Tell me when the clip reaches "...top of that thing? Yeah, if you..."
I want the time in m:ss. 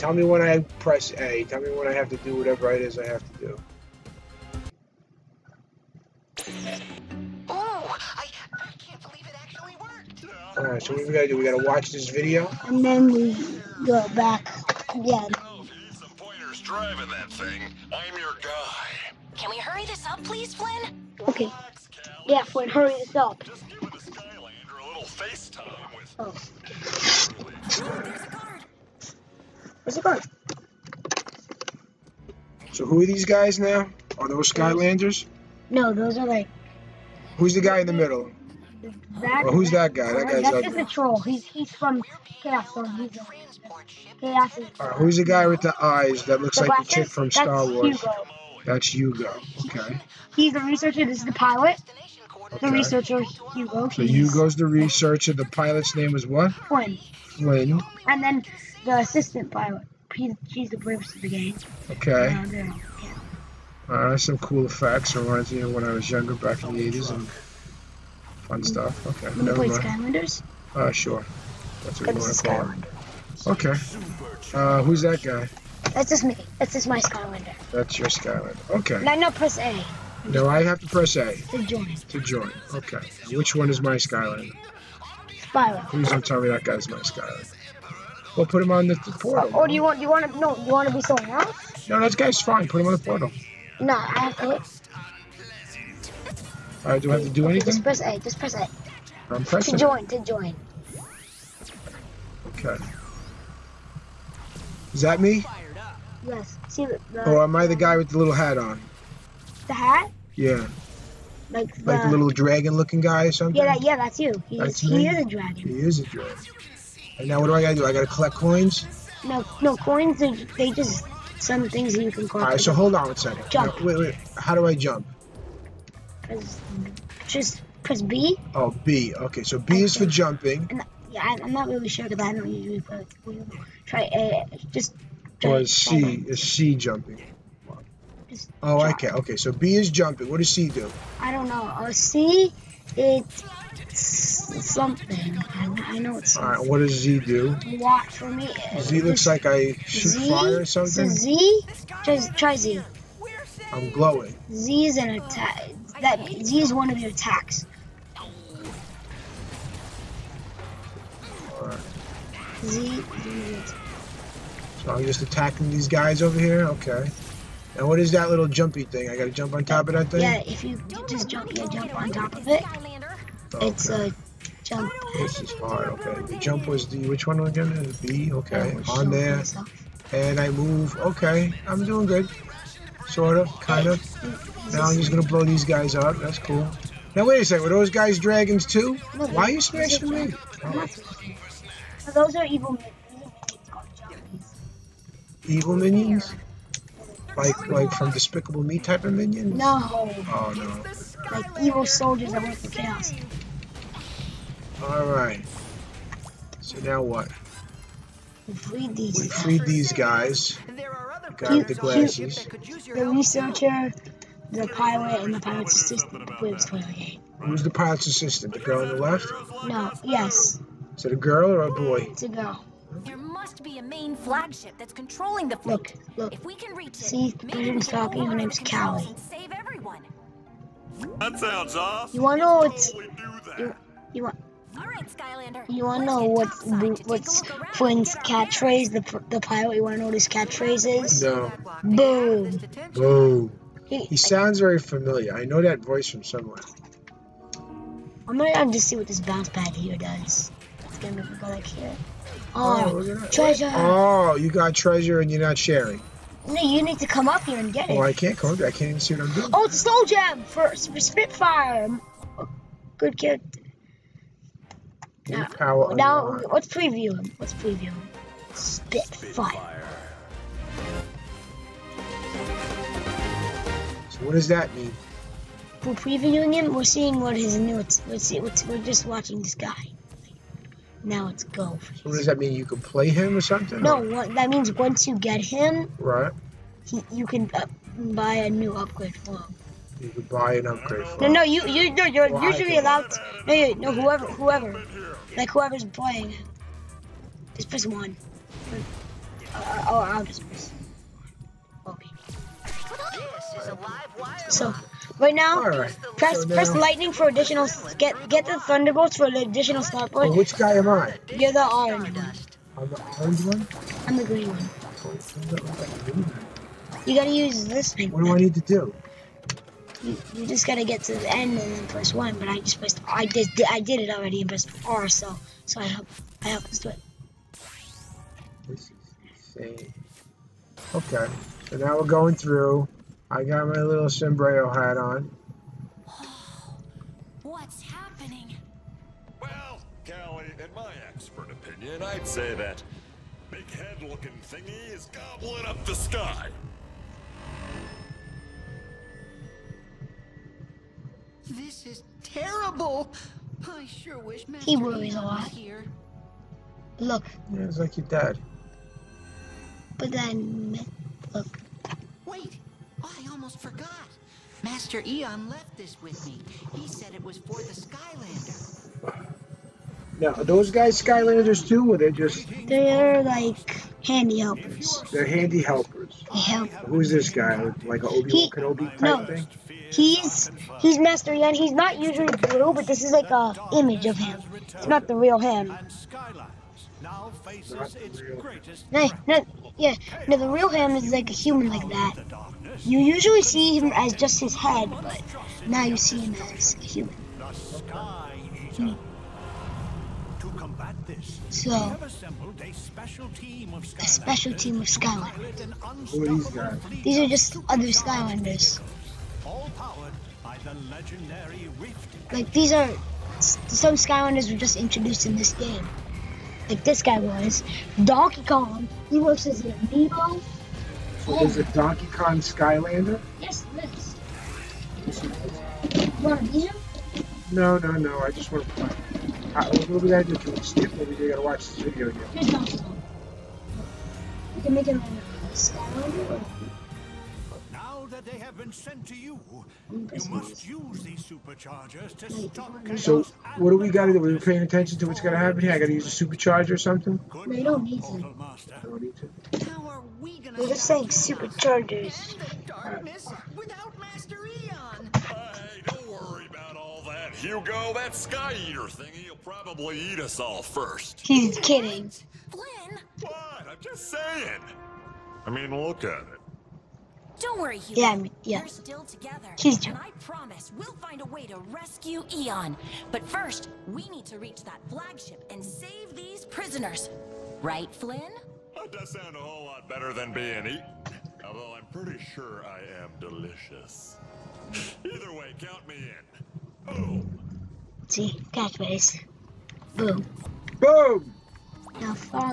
2:49.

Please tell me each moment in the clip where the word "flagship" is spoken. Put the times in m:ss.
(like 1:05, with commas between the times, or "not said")
3:44, 7:54.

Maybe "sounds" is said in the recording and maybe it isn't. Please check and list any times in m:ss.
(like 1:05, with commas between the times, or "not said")
3:51, 4:04, 7:59.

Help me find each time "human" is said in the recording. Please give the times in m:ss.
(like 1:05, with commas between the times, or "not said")
6:31, 6:36.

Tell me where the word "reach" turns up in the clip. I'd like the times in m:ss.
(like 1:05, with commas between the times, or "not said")
3:46, 7:54.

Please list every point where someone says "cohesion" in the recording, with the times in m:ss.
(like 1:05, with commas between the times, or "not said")
not said.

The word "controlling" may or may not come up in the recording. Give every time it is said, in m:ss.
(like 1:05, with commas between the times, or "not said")
3:44.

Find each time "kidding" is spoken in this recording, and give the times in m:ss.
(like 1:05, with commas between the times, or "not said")
7:41.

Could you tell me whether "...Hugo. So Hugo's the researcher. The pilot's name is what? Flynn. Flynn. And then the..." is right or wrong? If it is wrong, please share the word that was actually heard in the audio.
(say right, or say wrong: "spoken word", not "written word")
right.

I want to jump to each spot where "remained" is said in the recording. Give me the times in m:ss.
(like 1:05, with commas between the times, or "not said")
not said.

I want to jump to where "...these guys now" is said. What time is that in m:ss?
0:33.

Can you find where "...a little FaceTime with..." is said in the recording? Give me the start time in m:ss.
0:24.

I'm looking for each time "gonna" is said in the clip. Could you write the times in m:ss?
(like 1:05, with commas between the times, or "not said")
3:05, 4:08.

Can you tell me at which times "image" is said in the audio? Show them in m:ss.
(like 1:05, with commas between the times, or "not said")
6:23.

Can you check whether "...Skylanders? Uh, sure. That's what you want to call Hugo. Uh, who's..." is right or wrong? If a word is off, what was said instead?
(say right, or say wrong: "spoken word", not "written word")
wrong: "Okay", not "Hugo".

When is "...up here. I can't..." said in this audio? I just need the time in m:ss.
4:18.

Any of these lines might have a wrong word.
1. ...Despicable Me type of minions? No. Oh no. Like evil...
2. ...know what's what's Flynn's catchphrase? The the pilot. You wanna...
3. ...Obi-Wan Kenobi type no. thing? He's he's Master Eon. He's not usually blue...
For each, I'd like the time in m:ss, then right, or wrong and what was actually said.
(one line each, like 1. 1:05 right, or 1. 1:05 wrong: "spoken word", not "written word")
1. 3:18 right
2. 3:56 right
3. 6:18 right.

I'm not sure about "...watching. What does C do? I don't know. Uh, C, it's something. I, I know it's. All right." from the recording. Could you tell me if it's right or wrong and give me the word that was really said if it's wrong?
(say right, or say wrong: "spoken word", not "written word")
wrong: "jumping", not "watching".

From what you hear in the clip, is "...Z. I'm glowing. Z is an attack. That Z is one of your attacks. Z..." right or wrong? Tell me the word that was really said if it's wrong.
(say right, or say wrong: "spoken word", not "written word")
right.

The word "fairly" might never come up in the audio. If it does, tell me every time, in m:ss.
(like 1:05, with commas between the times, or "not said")
not said.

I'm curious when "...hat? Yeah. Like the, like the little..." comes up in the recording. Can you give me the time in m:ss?
1:49.